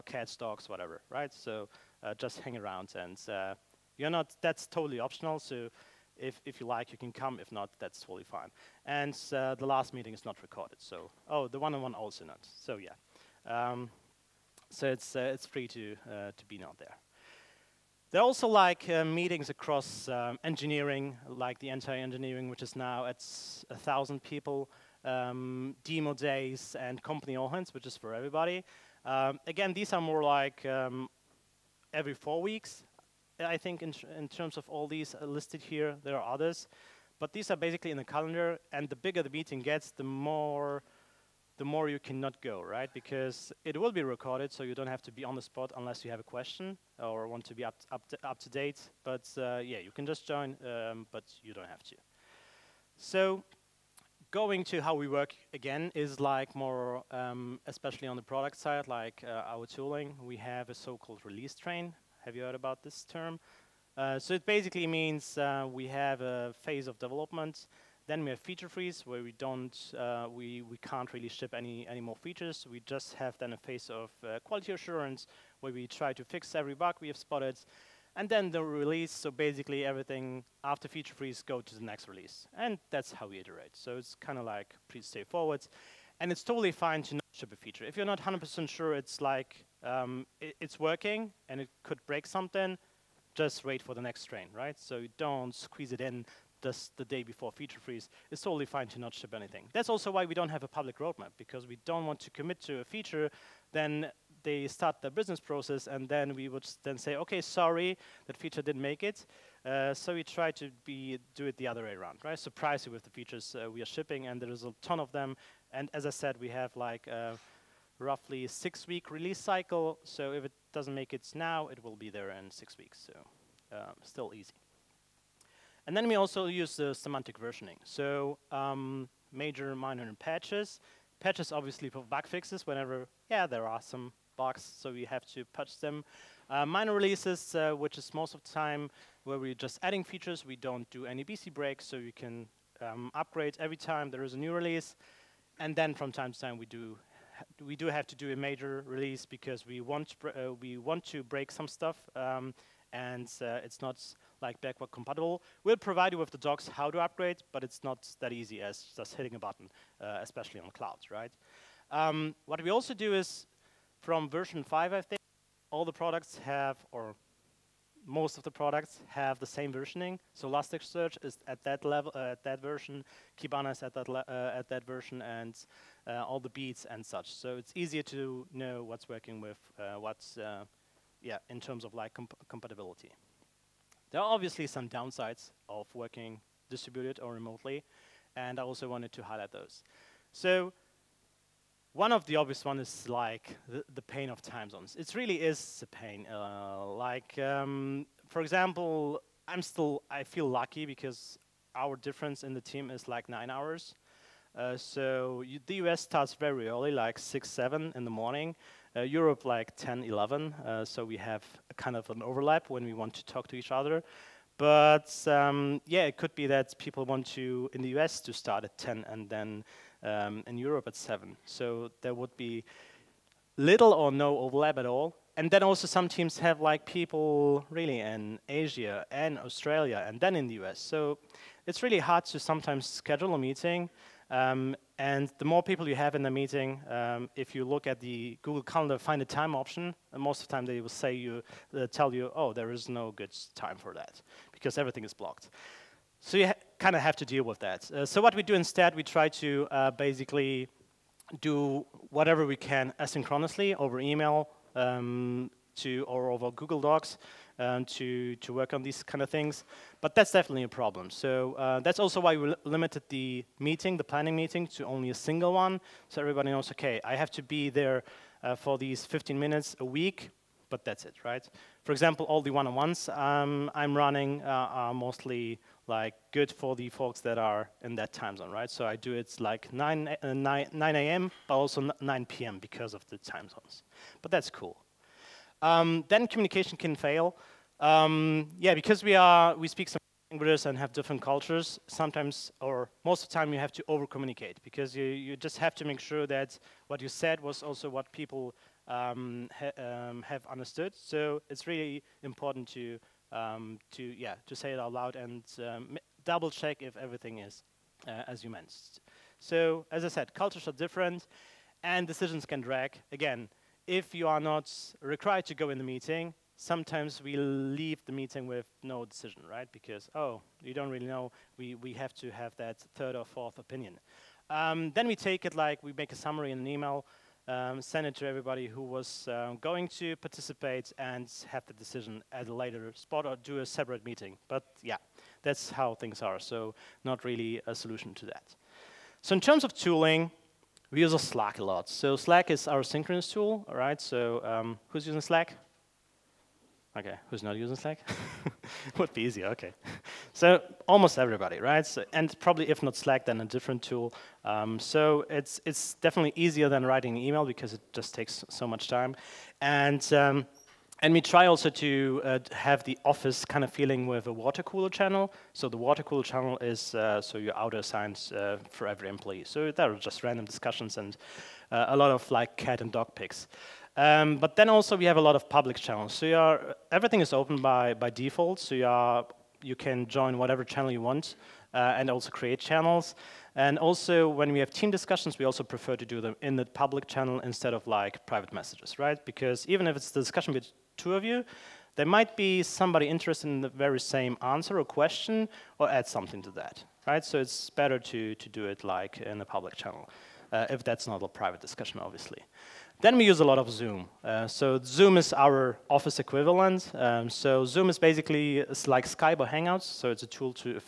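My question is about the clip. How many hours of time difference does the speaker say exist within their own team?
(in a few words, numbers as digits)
9 hours.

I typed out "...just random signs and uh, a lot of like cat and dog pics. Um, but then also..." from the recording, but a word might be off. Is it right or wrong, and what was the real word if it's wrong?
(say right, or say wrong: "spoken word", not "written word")
wrong: "discussions", not "signs".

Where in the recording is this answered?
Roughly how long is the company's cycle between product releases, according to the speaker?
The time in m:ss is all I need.
1:58.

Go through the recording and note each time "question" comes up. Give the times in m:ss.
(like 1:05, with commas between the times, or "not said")
0:46, 6:34.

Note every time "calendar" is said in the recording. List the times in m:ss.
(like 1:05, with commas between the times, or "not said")
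0:38, 3:58.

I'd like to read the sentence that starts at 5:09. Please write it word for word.
So as I said, cultures are different, and decisions can drag.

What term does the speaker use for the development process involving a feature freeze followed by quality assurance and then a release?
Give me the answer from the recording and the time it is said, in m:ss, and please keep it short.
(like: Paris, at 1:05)
release train, at 1:01.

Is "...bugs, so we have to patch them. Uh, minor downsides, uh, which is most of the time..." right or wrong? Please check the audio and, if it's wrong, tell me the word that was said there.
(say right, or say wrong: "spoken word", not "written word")
wrong: "releases", not "downsides".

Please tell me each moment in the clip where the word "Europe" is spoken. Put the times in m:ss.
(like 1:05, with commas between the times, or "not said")
3:29, 3:40.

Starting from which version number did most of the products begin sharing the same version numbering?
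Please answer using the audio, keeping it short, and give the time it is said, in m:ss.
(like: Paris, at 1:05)
5, at 2:44.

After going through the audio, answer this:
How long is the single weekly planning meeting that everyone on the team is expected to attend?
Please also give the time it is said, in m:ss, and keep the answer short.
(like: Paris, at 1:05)
15 minutes, at 4:29.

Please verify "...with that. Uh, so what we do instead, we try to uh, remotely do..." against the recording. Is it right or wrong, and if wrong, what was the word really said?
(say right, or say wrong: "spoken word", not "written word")
wrong: "basically", not "remotely".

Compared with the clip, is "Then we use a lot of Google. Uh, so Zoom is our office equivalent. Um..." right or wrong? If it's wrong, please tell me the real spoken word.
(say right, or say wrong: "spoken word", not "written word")
wrong: "Zoom", not "Google".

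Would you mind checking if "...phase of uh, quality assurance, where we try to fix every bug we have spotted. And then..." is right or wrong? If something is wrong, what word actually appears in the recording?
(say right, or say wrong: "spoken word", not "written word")
right.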